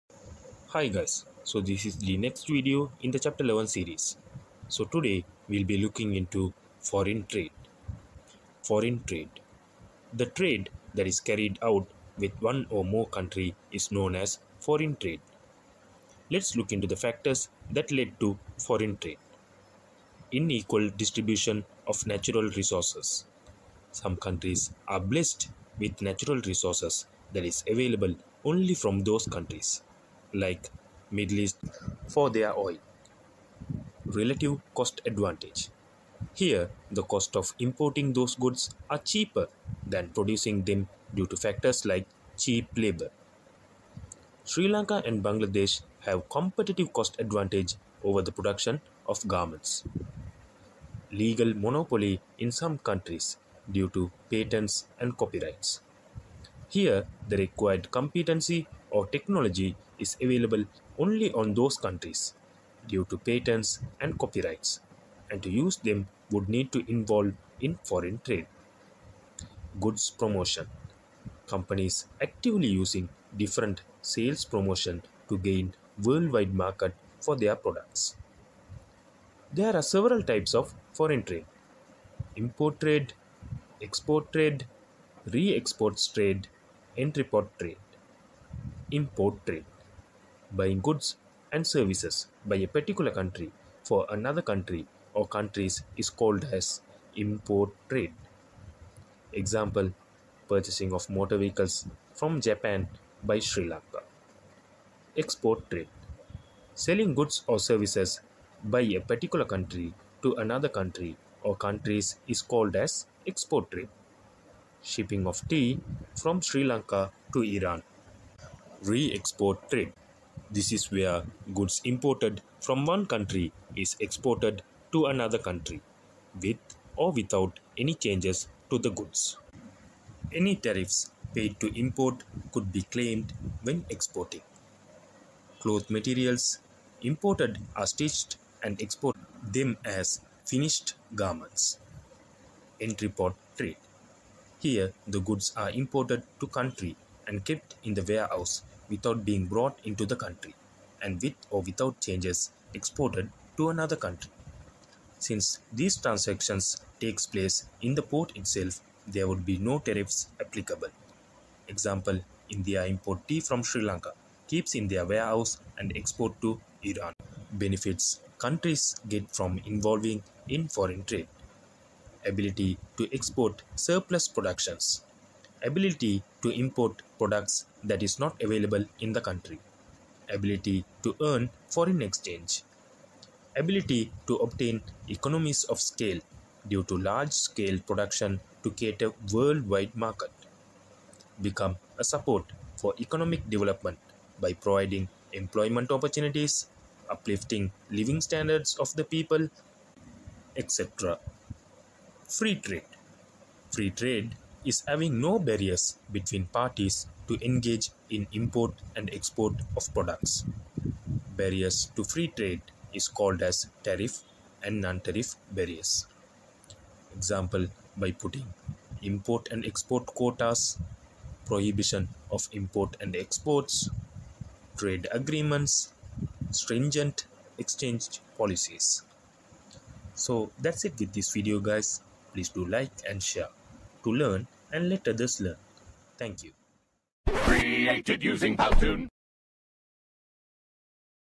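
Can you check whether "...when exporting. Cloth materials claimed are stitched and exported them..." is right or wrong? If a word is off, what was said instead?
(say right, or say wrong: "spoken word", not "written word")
wrong: "imported", not "claimed".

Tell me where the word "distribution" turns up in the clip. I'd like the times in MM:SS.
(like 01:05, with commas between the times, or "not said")
00:21.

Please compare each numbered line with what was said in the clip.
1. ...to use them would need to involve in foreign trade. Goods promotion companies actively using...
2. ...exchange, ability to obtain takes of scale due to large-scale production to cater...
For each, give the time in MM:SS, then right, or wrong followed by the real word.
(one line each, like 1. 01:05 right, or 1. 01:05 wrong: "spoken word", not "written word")
1. 01:05 right
2. 03:02 wrong: "economies", not "takes".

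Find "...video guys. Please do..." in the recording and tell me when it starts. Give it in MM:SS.
03:51.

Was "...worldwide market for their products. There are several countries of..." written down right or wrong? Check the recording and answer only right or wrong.
wrong.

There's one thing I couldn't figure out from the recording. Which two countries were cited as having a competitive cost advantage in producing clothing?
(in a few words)
Sri Lanka and Bangladesh.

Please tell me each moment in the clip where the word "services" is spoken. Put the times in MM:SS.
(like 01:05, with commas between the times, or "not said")
01:31, 01:47.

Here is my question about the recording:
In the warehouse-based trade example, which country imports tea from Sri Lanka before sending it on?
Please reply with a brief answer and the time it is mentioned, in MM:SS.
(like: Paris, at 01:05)
India, at 02:42.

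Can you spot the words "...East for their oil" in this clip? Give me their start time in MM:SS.
00:31.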